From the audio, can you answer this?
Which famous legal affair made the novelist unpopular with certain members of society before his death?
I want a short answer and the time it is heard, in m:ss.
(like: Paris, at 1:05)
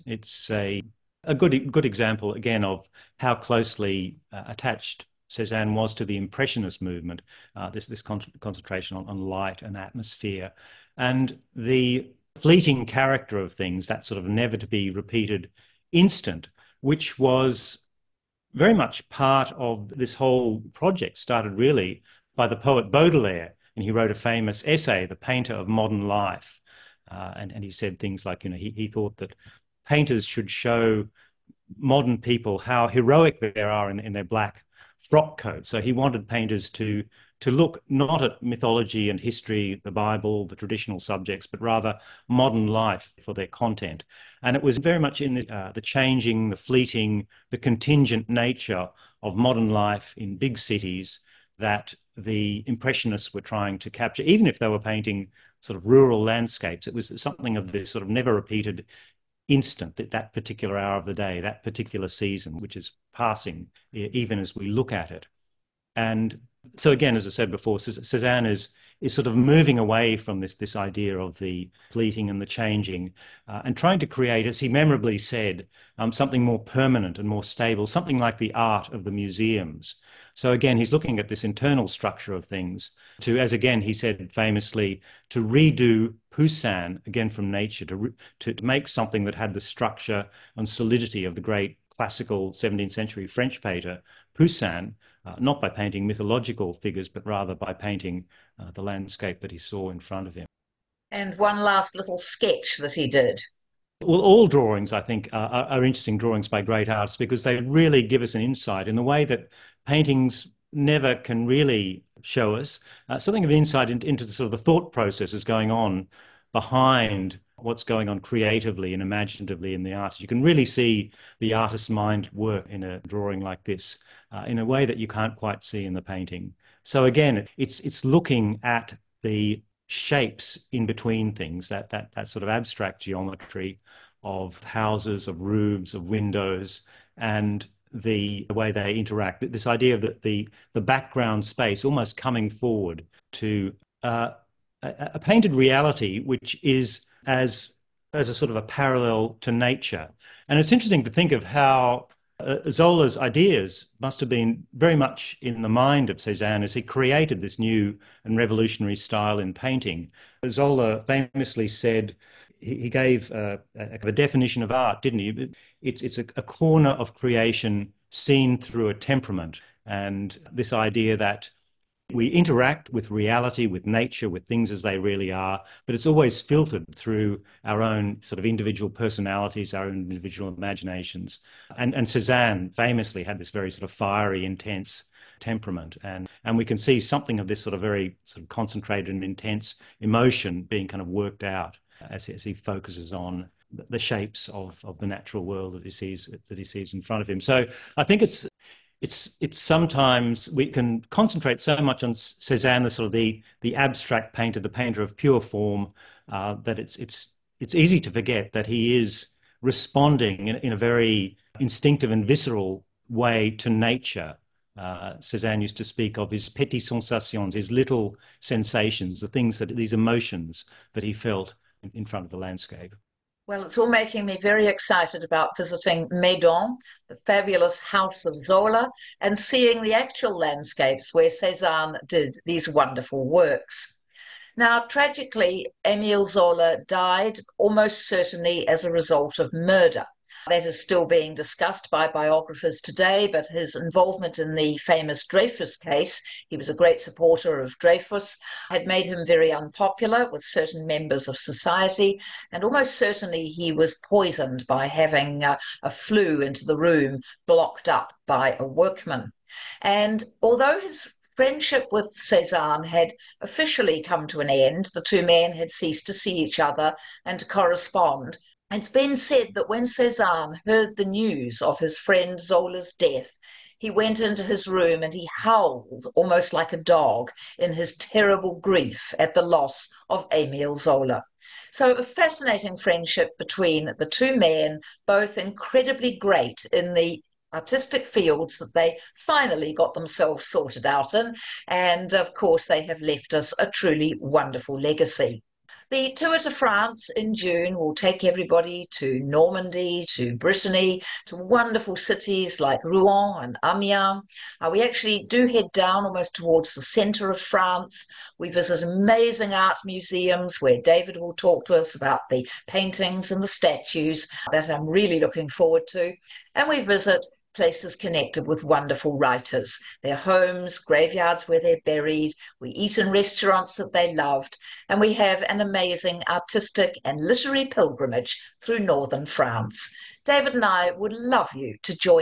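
Dreyfus case, at 4:05.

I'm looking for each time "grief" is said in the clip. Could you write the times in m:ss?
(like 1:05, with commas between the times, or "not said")
4:38.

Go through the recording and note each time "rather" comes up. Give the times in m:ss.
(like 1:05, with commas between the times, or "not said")
0:41, 1:37.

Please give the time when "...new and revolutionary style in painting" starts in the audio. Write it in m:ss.
2:37.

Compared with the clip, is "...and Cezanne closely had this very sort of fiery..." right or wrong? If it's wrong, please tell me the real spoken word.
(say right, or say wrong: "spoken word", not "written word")
wrong: "famously", not "closely".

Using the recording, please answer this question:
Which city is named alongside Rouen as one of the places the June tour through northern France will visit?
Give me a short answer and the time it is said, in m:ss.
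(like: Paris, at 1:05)
Amiens, at 5:03.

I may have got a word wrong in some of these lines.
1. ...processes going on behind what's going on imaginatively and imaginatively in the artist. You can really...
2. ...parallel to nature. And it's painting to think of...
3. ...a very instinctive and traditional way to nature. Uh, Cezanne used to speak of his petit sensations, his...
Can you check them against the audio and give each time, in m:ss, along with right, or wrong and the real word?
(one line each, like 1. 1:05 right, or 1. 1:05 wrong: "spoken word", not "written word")
1. 1:54 wrong: "creatively", not "imaginatively"
2. 2:28 wrong: "interesting", not "painting"
3. 3:30 wrong: "visceral", not "traditional".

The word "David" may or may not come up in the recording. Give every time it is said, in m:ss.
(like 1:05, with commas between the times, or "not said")
5:10, 5:30.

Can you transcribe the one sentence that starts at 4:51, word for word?
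And of course, they have left us a truly wonderful legacy.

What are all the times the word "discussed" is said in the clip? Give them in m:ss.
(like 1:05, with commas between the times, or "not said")
4:01.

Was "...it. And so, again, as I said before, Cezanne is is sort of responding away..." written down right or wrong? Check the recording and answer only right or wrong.
wrong.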